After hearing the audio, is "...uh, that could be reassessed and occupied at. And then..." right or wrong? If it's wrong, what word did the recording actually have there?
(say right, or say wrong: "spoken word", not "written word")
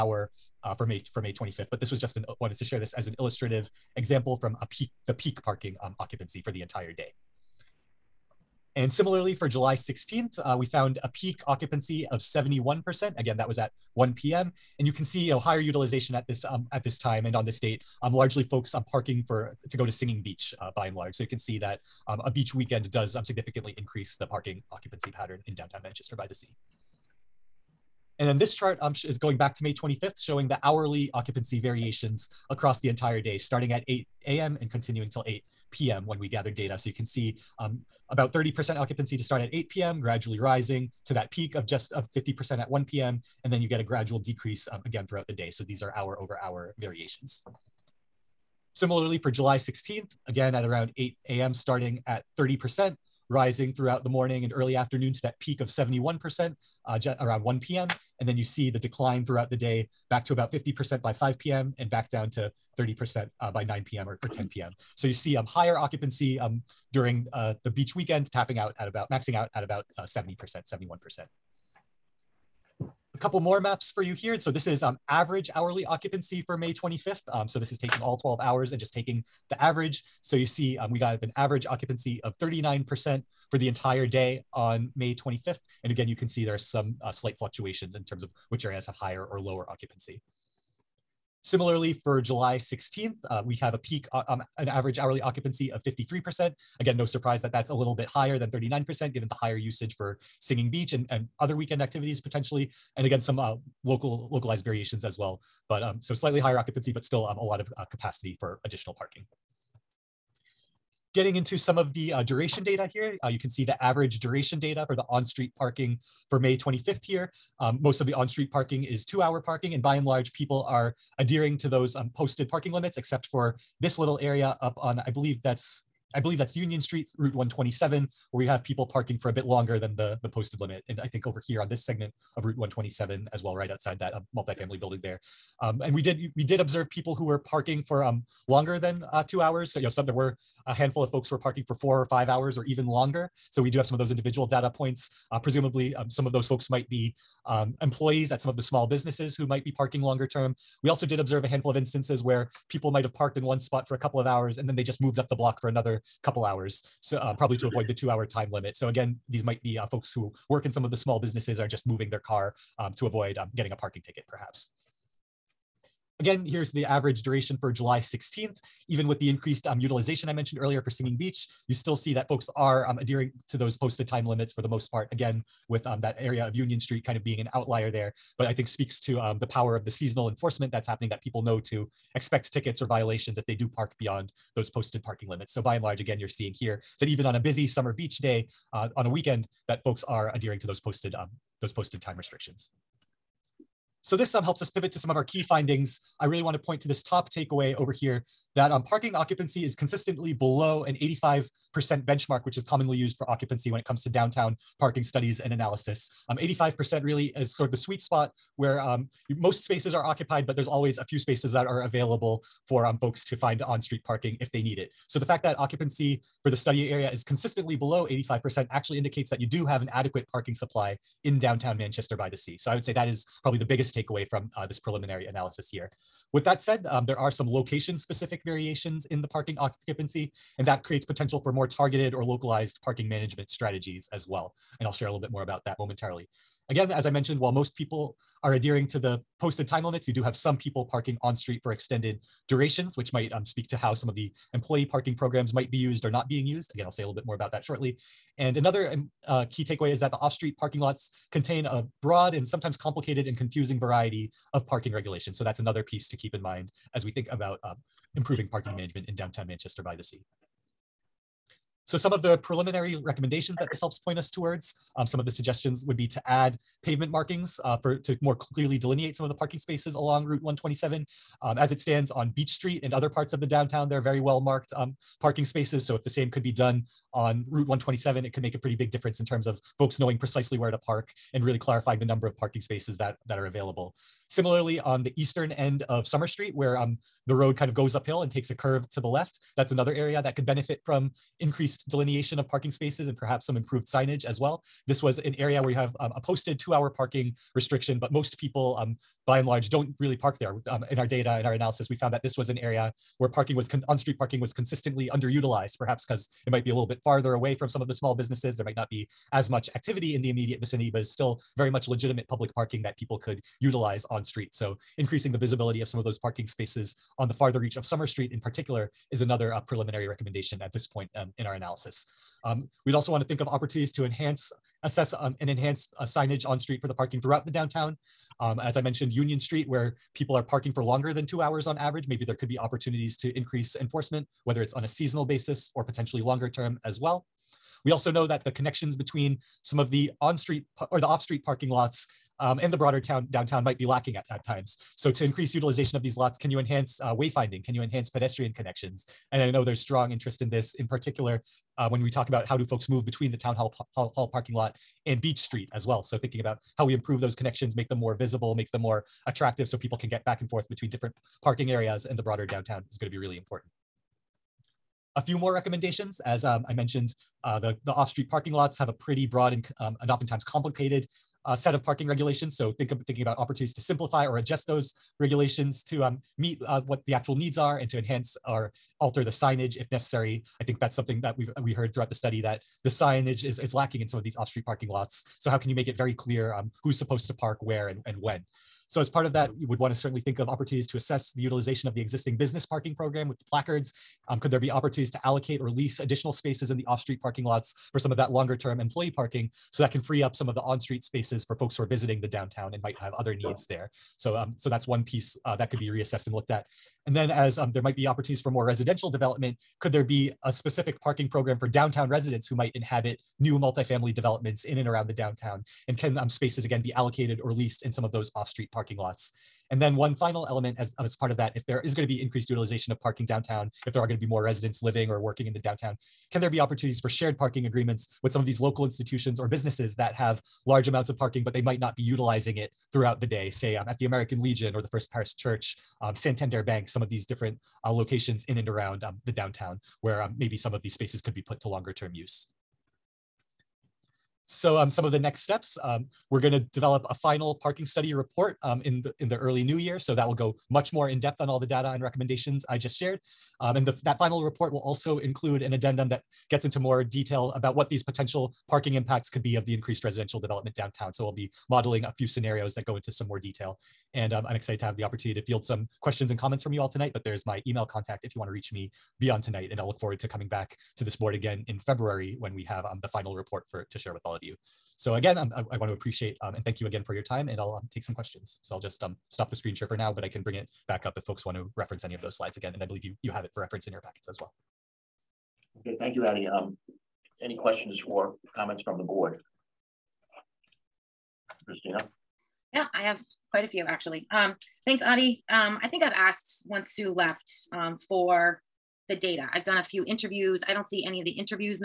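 wrong: "looked", not "occupied".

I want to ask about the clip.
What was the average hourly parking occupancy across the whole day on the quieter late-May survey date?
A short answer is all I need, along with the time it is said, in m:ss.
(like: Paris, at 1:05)
39%, at 1:21.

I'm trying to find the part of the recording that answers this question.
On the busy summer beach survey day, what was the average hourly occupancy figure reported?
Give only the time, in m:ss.
1:34.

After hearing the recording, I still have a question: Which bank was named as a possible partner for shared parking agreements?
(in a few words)
Santander Bank.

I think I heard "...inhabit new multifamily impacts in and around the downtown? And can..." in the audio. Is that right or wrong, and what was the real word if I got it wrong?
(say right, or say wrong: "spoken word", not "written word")
wrong: "developments", not "impacts".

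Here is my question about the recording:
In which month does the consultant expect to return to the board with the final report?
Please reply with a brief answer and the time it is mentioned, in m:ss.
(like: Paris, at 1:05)
February, at 7:51.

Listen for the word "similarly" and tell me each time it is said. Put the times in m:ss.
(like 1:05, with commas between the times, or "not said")
0:08, 0:48, 1:31, 4:44.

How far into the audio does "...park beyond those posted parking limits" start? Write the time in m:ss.
3:03.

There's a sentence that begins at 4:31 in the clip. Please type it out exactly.
Um, as it stands on Beach Street and other parts of the downtown, there are very well marked um, parking spaces.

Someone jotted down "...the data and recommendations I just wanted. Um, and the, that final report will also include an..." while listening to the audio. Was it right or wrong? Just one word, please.
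wrong.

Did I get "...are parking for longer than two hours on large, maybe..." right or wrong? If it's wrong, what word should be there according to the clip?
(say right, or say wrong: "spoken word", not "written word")
wrong: "average", not "large".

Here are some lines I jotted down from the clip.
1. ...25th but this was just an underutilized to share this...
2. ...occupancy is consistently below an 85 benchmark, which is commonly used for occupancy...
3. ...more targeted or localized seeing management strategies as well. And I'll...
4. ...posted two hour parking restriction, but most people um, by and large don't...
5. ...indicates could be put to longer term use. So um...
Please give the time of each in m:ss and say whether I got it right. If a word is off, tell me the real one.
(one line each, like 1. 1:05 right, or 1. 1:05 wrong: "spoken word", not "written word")
1. 0:01 wrong: "wanted", not "underutilized"
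2. 3:19 right
3. 3:51 wrong: "parking", not "seeing"
4. 4:56 right
5. 7:20 wrong: "spaces", not "indicates".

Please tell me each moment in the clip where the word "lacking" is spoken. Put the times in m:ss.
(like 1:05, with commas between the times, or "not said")
5:43, 6:23.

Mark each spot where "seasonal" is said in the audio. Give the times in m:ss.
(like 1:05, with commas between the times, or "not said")
2:59, 5:34.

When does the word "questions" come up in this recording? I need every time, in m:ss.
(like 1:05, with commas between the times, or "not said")
7:46, 7:58, 8:07.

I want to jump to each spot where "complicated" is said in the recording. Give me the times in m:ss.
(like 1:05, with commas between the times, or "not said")
4:12, 6:10.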